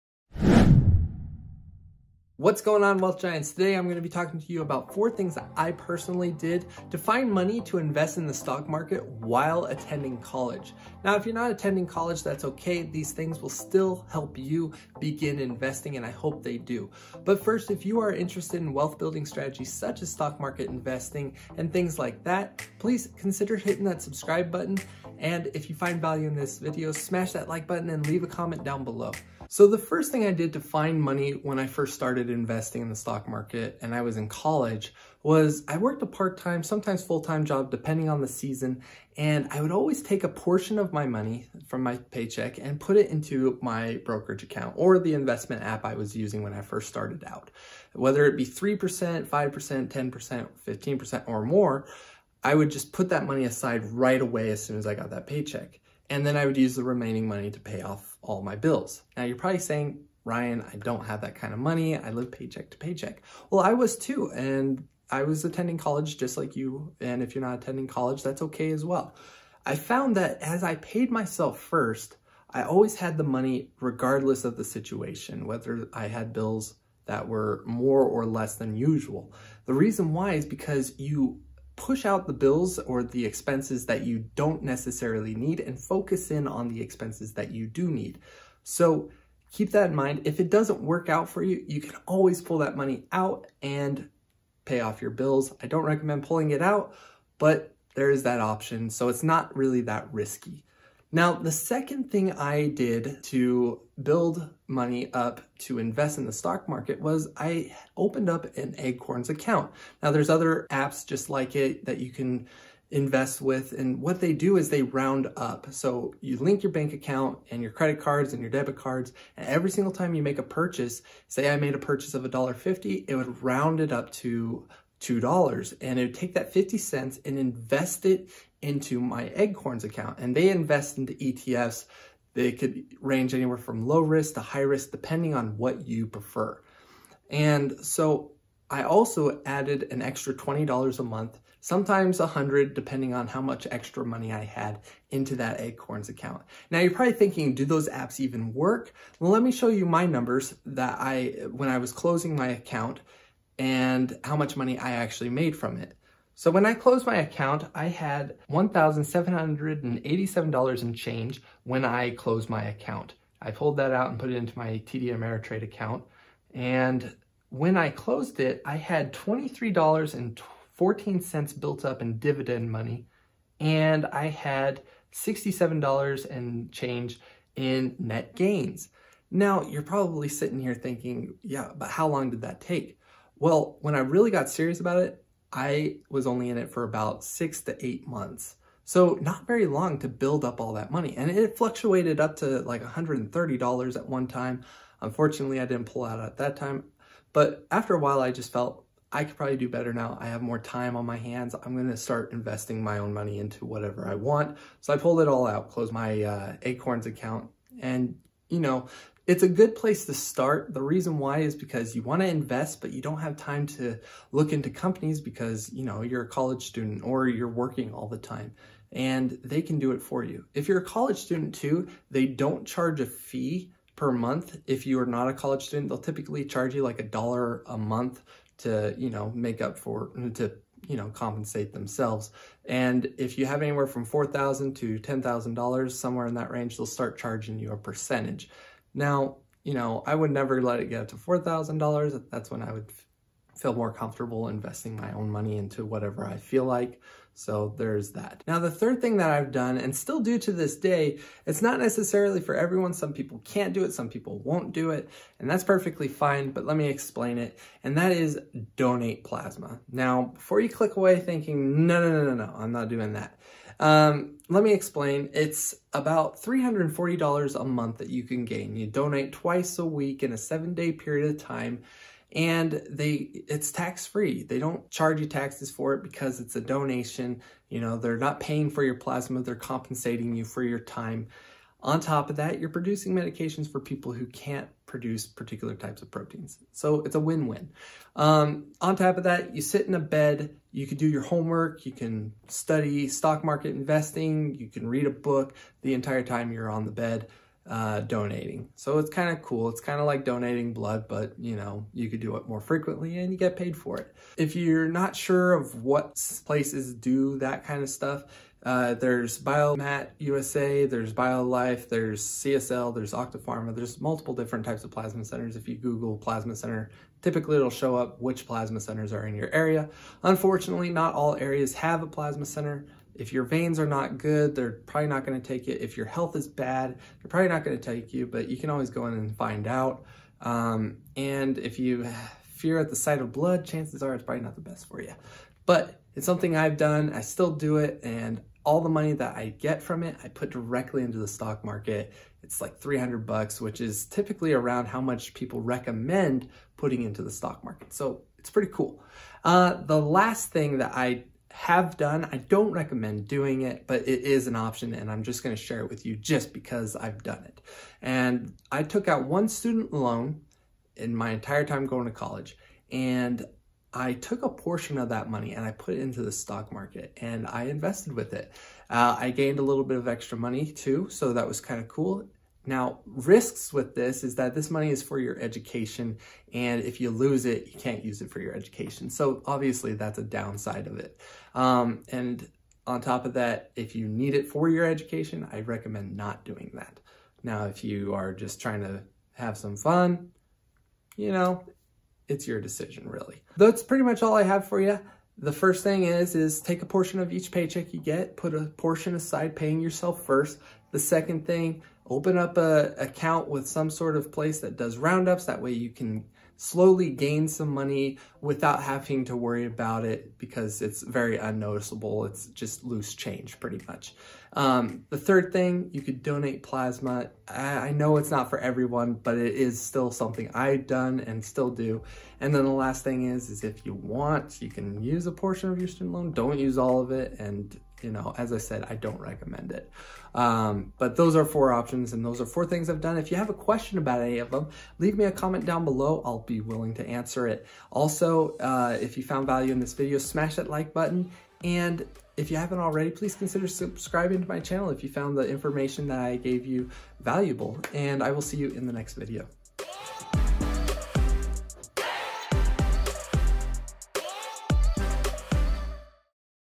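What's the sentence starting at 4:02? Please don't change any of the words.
That's when I would feel more comfortable investing my own money into whatever I feel like.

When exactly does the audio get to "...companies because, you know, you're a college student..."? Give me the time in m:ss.
3:34.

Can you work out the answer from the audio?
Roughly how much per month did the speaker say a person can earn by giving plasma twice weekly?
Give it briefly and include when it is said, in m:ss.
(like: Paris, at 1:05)
$340, at 4:26.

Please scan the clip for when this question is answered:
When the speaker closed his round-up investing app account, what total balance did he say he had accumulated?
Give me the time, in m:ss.
2:38.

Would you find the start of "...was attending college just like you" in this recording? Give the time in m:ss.
1:05.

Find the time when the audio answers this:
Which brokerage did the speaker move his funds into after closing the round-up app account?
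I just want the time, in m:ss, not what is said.
2:44.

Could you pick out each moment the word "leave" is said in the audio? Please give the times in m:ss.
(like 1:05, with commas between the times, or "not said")
0:28, 7:14.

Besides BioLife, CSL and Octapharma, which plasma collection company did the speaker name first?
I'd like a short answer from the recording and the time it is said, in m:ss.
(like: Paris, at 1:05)
Biomat USA, at 5:09.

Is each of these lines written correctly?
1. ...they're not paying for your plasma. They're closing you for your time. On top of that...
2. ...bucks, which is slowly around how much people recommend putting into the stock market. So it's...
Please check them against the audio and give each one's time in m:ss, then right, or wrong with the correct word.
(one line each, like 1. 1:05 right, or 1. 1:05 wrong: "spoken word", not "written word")
1. 4:37 wrong: "compensating", not "closing"
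2. 5:43 wrong: "typically", not "slowly".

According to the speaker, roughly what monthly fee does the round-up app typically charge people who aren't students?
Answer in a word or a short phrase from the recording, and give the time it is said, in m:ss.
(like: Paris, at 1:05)
$1, at 3:46.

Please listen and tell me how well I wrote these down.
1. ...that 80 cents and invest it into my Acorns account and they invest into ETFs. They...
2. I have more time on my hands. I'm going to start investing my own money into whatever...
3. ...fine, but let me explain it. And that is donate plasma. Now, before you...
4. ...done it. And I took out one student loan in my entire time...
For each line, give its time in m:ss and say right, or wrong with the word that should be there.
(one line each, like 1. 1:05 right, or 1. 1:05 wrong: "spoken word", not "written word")
1. 2:06 wrong: "50", not "80"
2. 3:20 right
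3. 4:16 right
4. 5:57 right.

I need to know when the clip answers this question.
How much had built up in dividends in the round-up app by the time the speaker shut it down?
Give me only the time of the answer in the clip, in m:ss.
2:49.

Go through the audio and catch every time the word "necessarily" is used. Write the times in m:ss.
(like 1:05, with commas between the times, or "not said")
1:24, 4:11.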